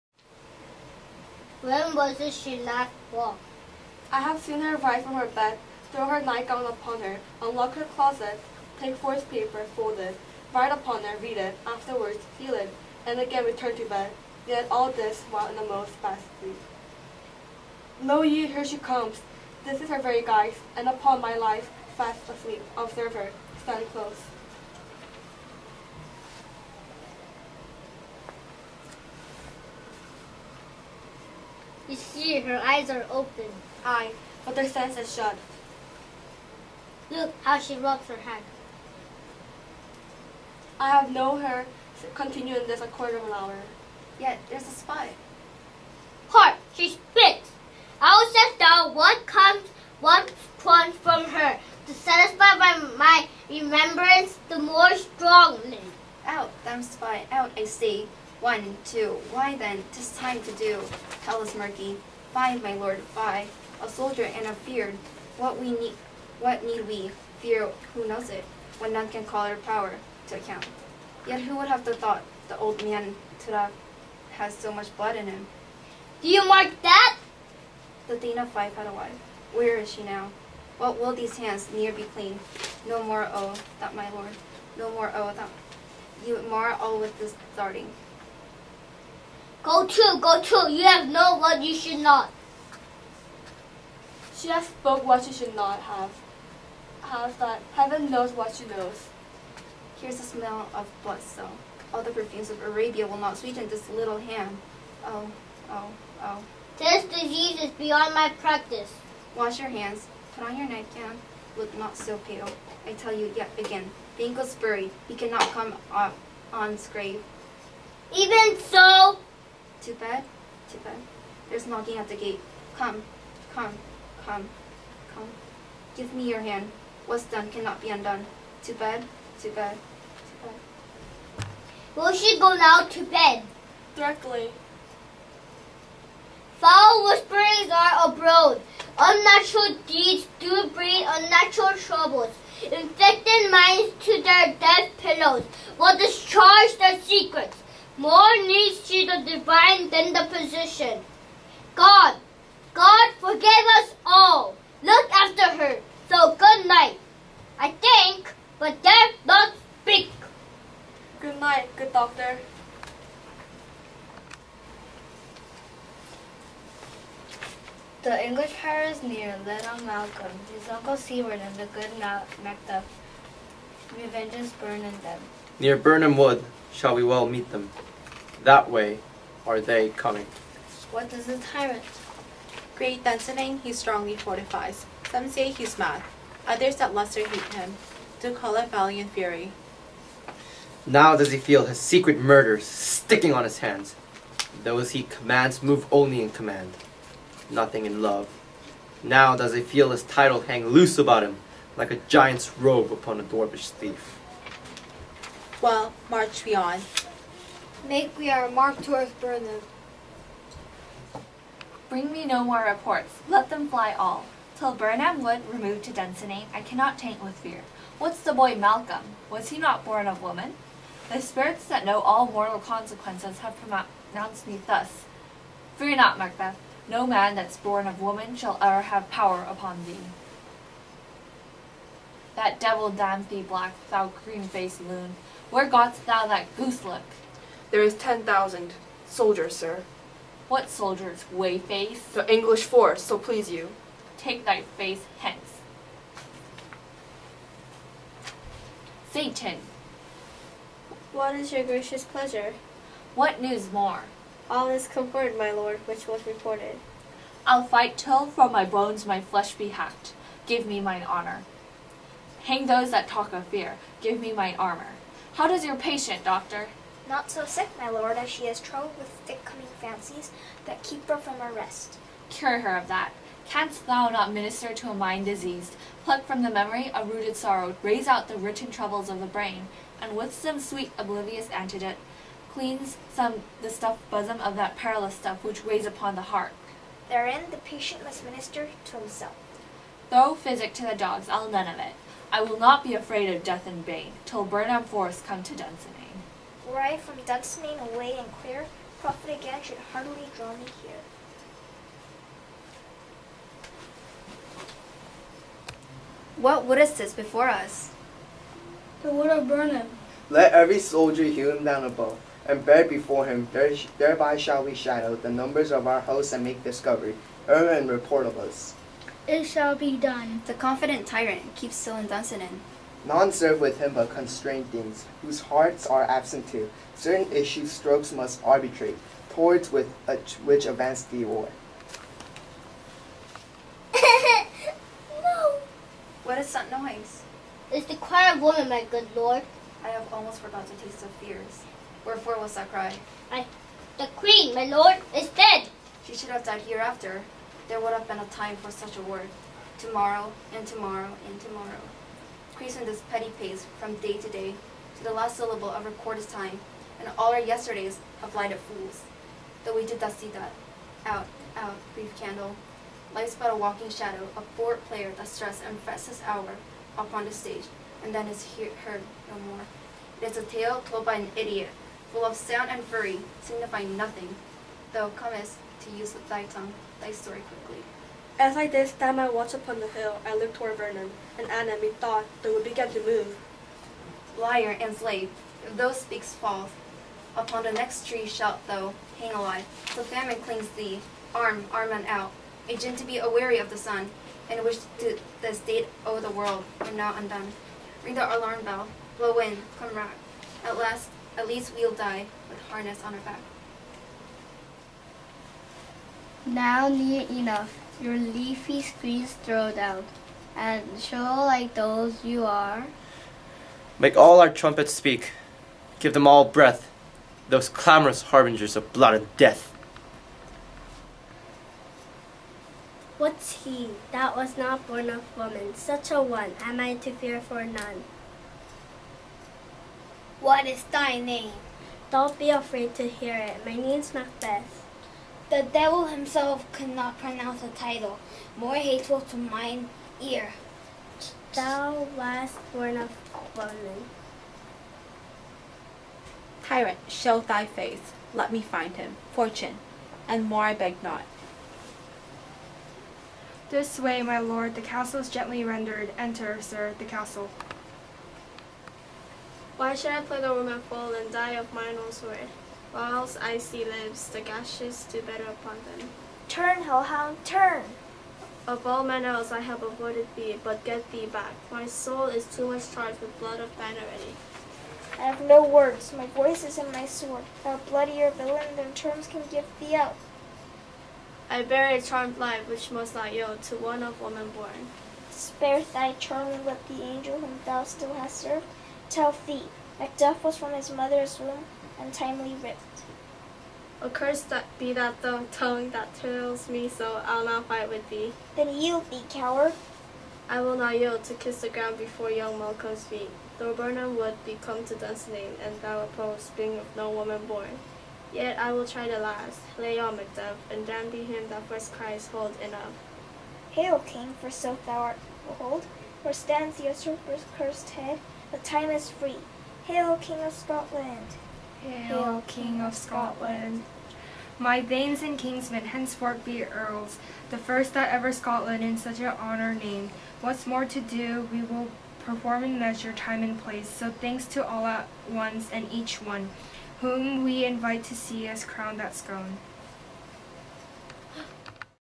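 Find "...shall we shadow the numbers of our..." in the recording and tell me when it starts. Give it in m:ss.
5:14.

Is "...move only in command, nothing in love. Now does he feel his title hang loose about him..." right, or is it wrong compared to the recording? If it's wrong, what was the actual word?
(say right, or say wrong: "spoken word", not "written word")
right.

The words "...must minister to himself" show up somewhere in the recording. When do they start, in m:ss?
4:48.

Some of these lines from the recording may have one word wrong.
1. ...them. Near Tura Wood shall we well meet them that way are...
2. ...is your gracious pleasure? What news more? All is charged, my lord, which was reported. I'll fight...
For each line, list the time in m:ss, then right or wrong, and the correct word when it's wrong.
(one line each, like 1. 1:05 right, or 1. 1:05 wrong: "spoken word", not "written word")
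1. 2:55 wrong: "Birnam", not "Tura"
2. 4:11 wrong: "confirmed", not "charged".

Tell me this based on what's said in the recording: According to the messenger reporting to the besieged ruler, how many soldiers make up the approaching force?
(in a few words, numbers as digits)
10,000.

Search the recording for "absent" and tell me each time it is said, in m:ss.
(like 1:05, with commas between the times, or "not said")
5:26.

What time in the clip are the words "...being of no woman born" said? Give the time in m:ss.
8:26.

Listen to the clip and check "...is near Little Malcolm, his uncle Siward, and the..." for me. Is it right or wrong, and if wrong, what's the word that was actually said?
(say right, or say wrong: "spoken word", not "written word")
right.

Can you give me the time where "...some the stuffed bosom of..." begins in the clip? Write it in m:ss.
4:43.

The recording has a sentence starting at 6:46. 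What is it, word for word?
Now near enough, your leafy screens throw down, and show like those you are.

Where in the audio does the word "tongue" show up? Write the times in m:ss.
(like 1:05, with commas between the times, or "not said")
6:16, 8:15.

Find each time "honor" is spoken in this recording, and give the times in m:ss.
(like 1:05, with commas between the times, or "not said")
4:21, 8:49.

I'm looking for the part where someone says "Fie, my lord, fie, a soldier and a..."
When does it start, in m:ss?
1:02.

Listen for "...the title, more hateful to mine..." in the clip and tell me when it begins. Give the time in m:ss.
7:17.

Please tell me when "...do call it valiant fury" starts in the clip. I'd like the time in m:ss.
3:08.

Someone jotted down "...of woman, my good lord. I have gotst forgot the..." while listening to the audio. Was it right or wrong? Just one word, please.
wrong.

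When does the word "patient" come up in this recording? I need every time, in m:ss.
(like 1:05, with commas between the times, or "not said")
4:25, 4:47.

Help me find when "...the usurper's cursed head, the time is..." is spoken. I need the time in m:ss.
8:36.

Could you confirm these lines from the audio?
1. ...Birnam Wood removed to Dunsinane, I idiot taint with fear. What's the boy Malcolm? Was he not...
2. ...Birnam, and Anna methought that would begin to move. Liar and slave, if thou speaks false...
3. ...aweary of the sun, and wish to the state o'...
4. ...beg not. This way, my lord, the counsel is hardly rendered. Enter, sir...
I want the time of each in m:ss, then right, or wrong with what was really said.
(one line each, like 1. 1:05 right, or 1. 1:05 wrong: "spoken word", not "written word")
1. 3:34 wrong: "cannot", not "idiot"
2. 6:20 right
3. 6:33 right
4. 7:30 wrong: "gently", not "hardly".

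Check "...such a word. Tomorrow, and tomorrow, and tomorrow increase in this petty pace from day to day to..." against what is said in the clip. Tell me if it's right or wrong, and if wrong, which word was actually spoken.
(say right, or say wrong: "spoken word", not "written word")
right.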